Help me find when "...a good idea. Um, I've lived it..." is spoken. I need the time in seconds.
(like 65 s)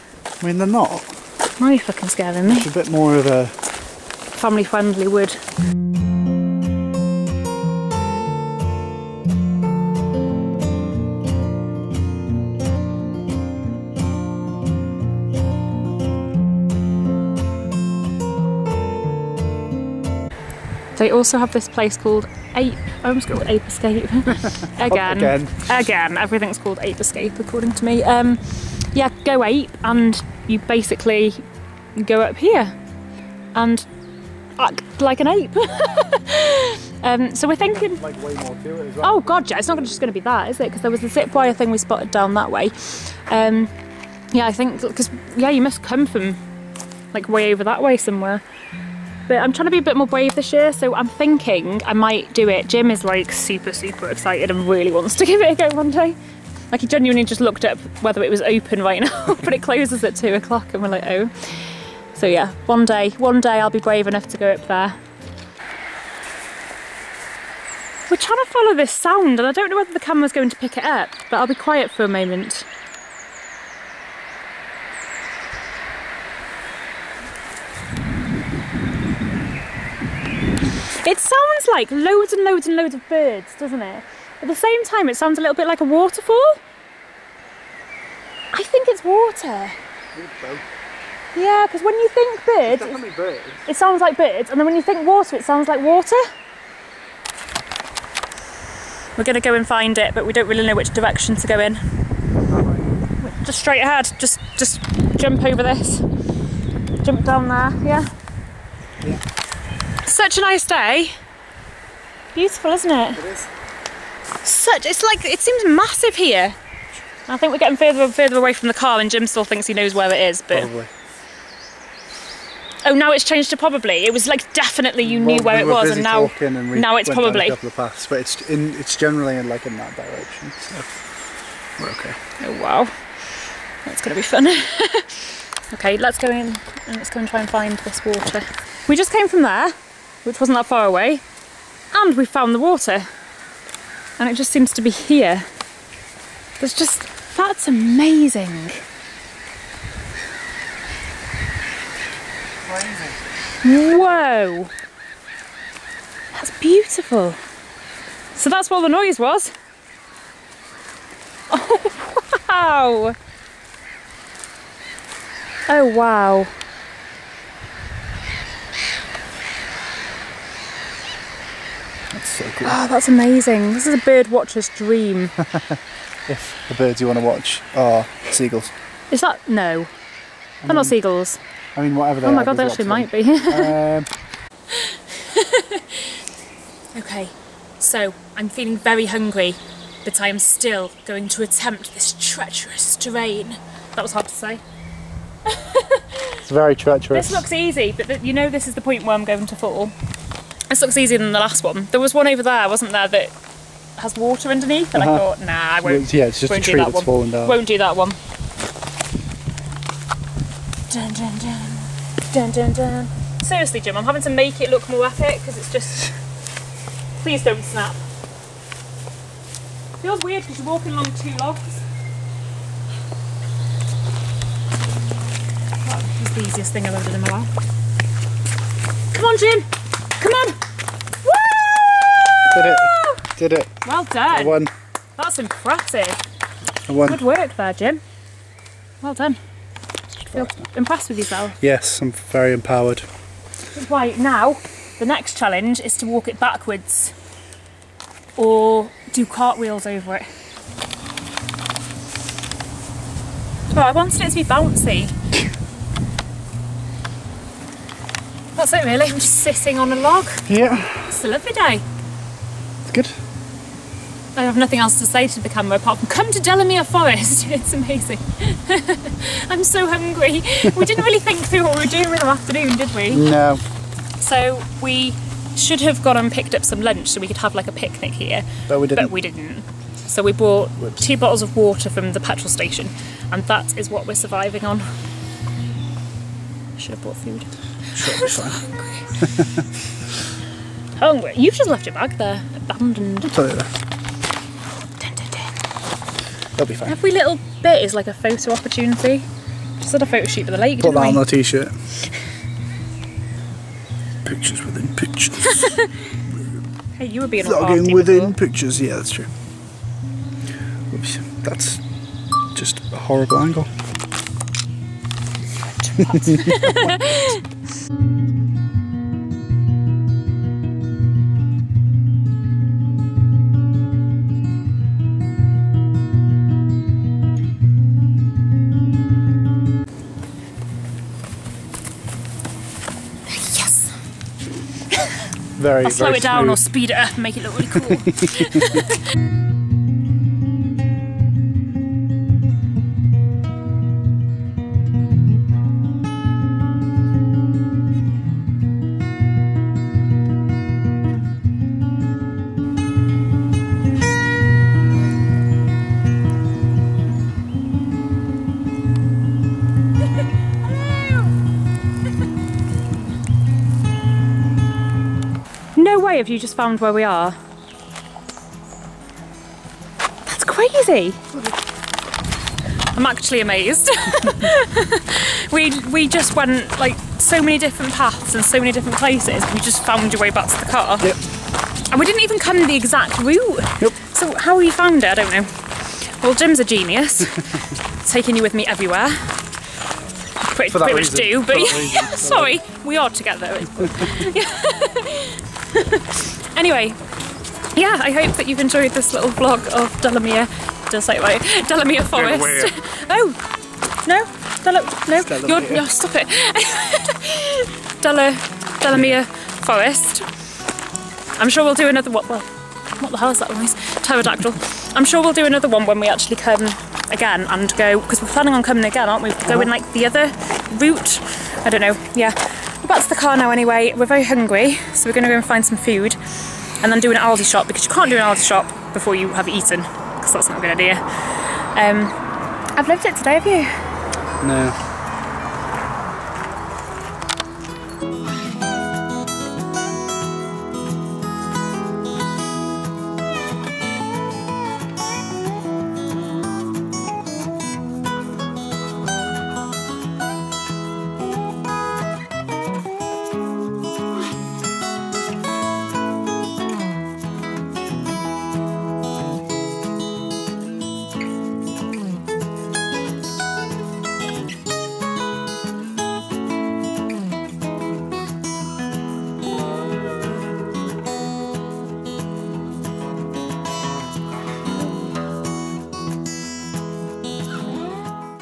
430 s.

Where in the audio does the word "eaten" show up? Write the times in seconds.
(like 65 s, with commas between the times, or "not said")
429 s.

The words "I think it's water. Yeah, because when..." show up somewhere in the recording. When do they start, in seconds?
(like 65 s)
88 s.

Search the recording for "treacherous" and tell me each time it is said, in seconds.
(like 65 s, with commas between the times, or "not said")
192 s, 196 s.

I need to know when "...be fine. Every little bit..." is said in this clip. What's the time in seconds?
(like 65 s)
296 s.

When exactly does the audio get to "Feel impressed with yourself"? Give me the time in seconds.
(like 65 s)
240 s.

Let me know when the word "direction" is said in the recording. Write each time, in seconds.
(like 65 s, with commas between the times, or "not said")
100 s, 129 s.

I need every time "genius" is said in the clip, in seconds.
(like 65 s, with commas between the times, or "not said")
386 s.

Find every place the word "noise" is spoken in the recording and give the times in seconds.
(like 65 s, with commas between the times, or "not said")
158 s, 413 s.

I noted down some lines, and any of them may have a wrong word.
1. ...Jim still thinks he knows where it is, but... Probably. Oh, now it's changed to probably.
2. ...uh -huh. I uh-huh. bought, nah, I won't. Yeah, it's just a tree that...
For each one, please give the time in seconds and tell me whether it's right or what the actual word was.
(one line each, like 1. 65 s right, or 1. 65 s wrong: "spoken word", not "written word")
1. 119 s right
2. 205 s wrong: "thought", not "bought".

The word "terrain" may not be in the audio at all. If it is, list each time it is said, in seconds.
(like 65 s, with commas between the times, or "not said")
192 s.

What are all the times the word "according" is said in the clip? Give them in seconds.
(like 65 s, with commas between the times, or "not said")
27 s.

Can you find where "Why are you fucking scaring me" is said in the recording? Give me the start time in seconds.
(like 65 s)
1 s.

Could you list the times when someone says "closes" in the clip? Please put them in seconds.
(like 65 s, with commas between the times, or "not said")
59 s.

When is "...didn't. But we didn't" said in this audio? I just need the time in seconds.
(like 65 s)
278 s.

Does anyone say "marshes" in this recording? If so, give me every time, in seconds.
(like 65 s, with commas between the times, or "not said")
not said.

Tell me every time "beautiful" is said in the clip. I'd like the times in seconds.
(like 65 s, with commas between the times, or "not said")
112 s, 156 s.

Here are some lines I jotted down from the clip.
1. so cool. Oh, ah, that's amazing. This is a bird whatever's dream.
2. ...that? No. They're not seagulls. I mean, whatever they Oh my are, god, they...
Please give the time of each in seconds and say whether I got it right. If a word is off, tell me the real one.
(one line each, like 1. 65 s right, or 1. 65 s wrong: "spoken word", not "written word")
1. 172 s wrong: "watcher", not "whatever"
2. 179 s right.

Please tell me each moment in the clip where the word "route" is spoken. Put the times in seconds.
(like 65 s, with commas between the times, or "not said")
383 s, 420 s.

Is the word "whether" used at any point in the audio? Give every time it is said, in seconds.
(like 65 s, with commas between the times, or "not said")
58 s, 69 s.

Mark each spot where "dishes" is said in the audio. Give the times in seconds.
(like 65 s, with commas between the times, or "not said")
not said.